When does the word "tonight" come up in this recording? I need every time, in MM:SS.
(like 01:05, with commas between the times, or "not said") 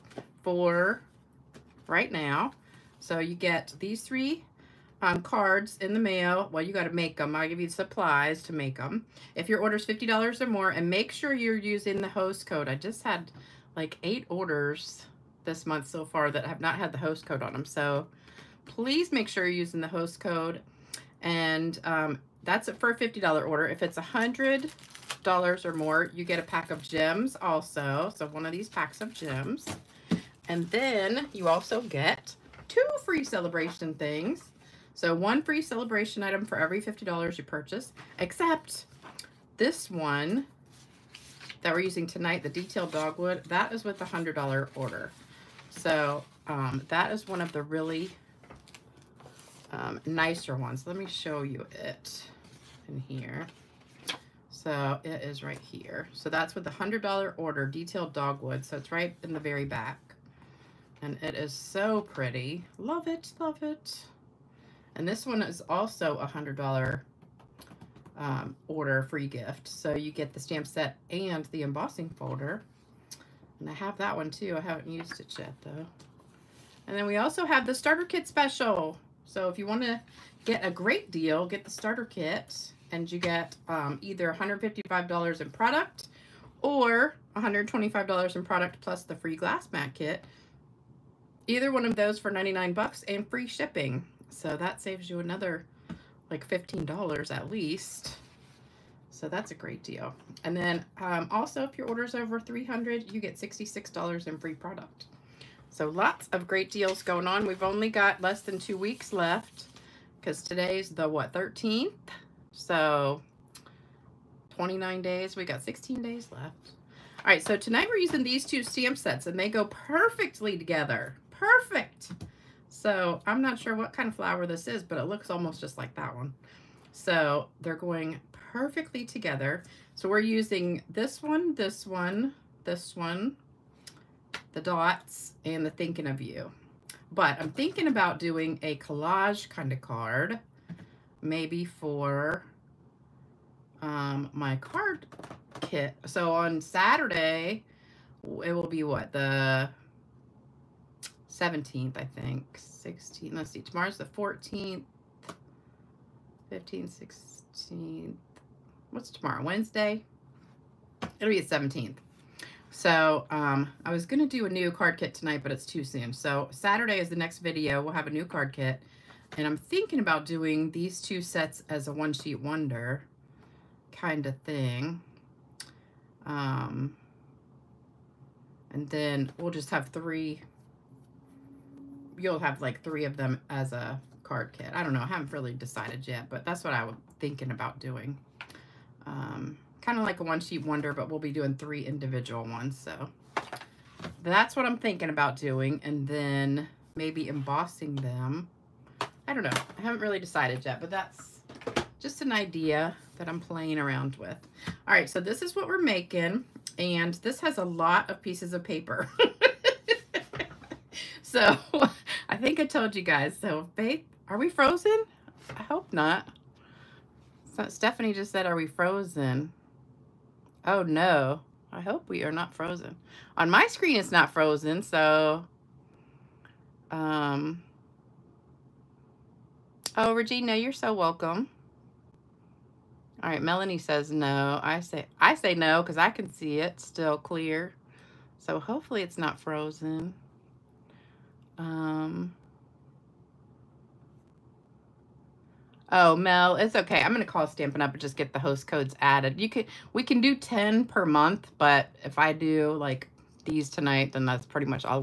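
00:42, 01:57, 02:45, 04:13.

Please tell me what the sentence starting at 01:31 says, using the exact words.
Either one of those for 99 bucks and free shipping.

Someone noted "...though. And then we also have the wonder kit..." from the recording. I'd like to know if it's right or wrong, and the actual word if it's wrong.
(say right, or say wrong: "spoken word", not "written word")
wrong: "starter", not "wonder".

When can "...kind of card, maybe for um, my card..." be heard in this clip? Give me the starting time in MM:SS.
02:19.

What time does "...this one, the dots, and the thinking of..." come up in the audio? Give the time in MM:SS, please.
02:12.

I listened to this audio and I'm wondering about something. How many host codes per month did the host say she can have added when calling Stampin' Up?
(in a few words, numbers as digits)
10.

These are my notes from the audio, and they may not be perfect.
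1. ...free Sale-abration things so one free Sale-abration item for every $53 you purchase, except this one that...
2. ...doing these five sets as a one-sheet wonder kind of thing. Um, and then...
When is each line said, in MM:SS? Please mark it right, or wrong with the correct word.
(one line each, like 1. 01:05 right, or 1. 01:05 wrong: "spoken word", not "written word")
1. 00:33 wrong: "50", not "53"
2. 02:50 wrong: "two", not "five".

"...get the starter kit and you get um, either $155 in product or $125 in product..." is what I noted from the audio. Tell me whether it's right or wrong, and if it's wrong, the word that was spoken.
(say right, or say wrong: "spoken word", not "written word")
right.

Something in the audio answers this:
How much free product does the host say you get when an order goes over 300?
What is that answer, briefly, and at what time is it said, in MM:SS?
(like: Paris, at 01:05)
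$66, at 01:43.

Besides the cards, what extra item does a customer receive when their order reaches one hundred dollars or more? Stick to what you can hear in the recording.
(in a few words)
A pack of gems.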